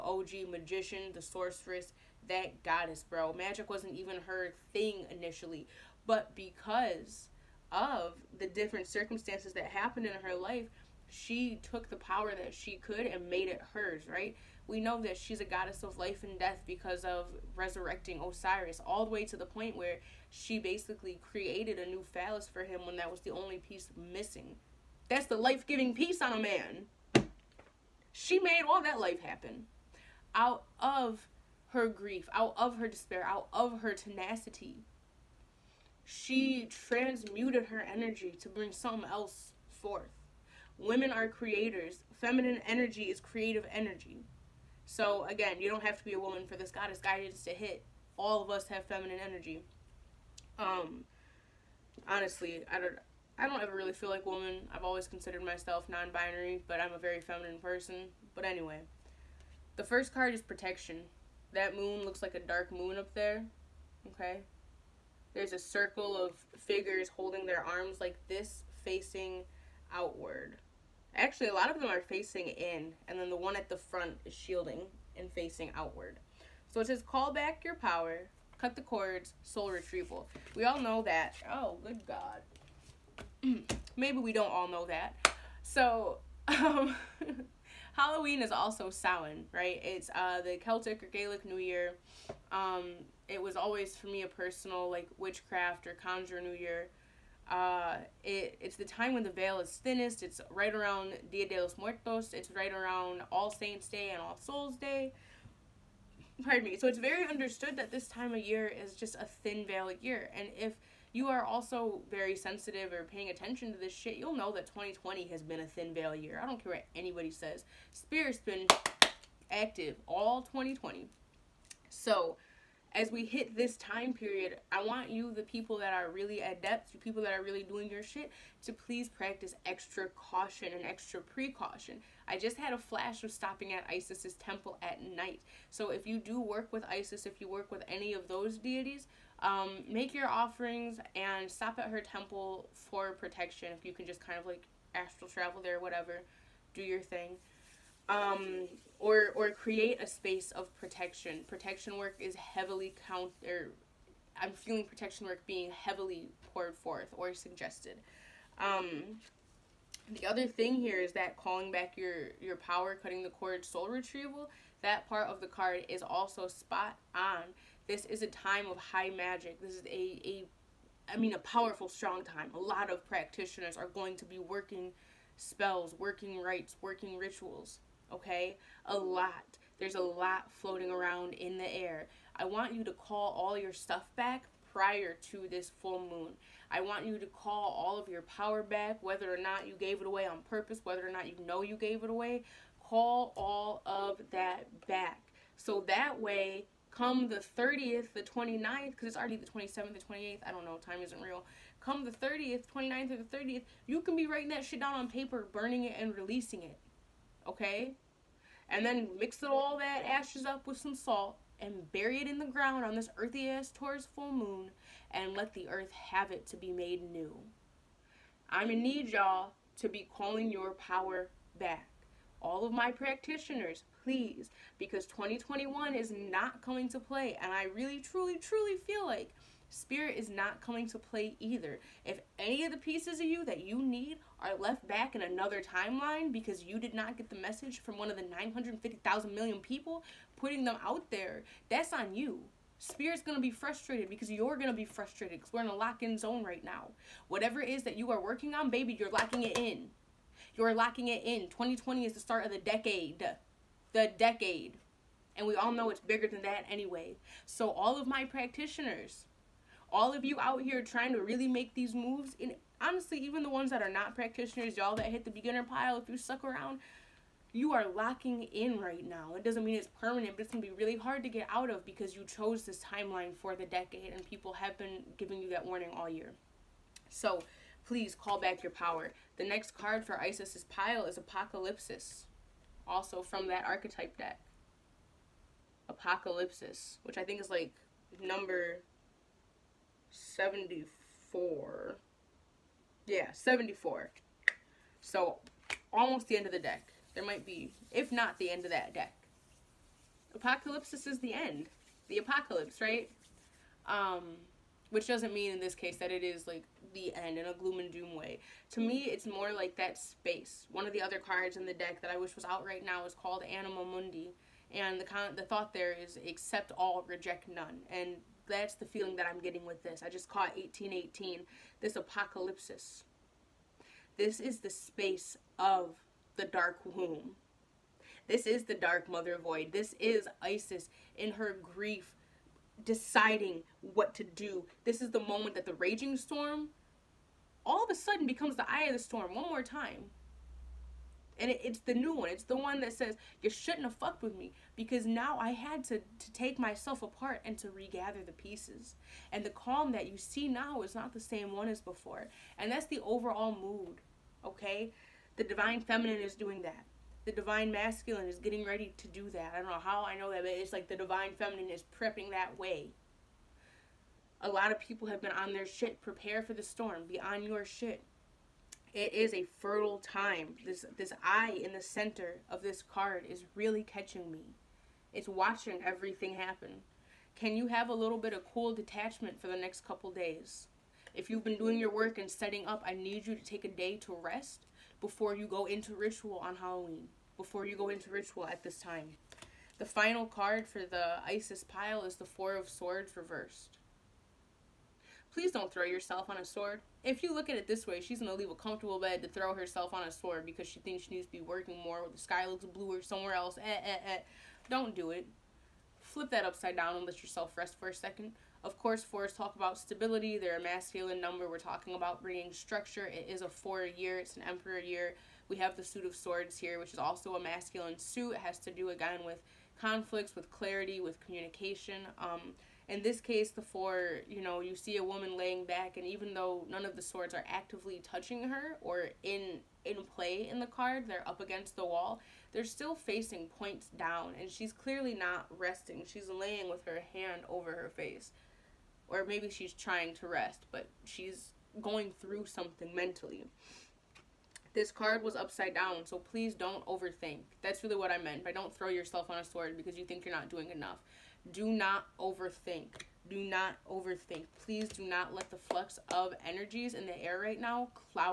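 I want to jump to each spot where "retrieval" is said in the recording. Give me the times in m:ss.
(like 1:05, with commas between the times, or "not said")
1:19, 2:43.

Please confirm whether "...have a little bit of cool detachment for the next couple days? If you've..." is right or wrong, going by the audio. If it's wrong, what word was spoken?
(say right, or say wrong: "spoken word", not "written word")
right.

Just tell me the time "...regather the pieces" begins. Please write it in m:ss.
5:47.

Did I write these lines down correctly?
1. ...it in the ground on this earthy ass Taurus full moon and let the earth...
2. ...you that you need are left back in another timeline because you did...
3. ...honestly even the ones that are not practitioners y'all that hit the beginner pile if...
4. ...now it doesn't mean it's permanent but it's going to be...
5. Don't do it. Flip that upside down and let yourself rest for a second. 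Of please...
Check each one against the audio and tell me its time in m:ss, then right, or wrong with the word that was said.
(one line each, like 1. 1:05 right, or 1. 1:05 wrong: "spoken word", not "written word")
1. 3:32 right
2. 3:53 right
3. 4:22 right
4. 4:29 right
5. 6:44 wrong: "course", not "please".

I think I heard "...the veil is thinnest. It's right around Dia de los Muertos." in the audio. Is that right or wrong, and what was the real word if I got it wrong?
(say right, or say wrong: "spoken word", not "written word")
right.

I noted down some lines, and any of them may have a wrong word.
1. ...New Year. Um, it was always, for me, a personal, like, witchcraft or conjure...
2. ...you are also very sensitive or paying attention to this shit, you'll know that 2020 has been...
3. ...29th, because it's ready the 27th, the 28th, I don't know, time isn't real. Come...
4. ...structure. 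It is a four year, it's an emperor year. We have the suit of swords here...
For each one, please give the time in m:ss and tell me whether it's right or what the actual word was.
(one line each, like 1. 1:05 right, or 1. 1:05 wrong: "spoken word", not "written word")
1. 1:31 right
2. 1:51 right
3. 3:18 wrong: "already", not "ready"
4. 6:52 right.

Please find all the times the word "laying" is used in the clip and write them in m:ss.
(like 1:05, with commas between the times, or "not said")
7:05, 7:16.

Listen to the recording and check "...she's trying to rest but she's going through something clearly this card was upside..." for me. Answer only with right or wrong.
wrong.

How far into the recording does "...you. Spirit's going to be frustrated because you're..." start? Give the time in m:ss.
4:02.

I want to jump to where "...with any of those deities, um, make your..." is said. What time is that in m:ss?
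2:17.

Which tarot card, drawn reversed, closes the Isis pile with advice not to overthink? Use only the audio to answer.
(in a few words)
Four of Swords.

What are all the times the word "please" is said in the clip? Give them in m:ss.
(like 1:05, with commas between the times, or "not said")
2:08, 3:44, 4:37, 6:35, 7:26, 7:34.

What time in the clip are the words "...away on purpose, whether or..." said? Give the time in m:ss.
3:10.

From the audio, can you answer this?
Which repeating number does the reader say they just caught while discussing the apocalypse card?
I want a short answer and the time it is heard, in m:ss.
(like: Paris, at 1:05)
1818, at 5:20.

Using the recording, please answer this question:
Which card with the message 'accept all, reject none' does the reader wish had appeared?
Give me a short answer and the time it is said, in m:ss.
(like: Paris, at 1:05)
Anima Mundi, at 5:13.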